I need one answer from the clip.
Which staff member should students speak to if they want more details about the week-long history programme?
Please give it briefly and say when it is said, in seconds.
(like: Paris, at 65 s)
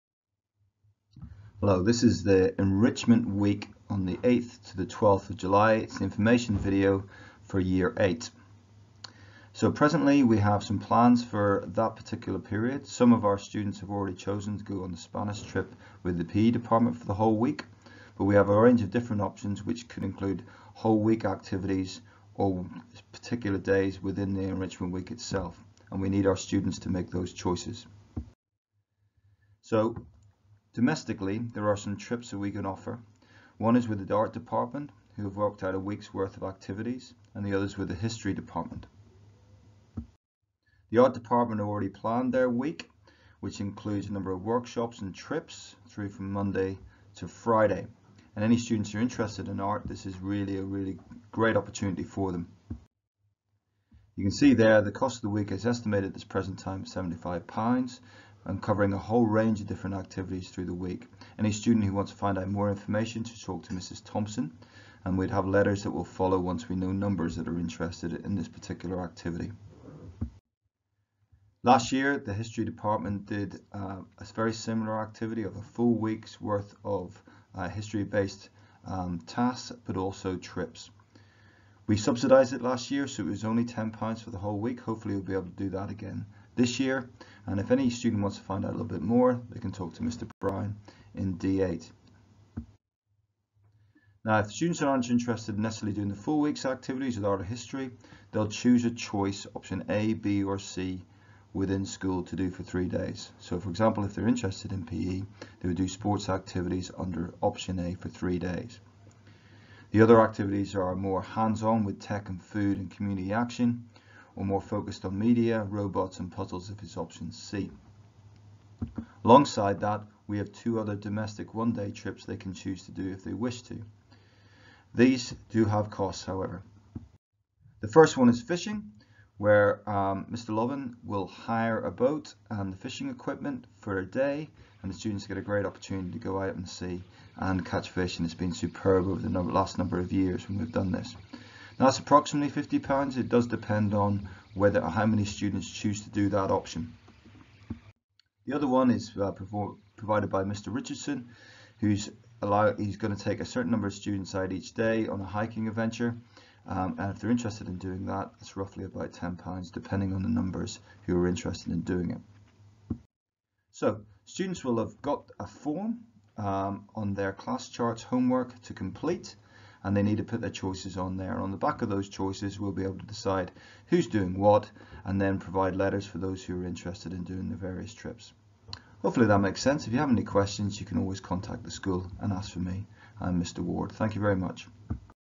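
Mr. Brown, at 90 s.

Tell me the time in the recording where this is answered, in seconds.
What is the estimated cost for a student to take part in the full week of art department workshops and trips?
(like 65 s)
56 s.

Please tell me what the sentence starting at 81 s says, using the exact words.
We subsidized it last year, so it was only £10 for the whole week.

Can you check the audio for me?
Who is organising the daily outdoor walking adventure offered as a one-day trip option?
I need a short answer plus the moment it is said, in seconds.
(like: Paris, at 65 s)
Mr. Richardson, at 150 s.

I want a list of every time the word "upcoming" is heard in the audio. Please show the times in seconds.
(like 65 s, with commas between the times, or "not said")
not said.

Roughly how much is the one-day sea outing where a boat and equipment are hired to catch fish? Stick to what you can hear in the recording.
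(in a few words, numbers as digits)
£50.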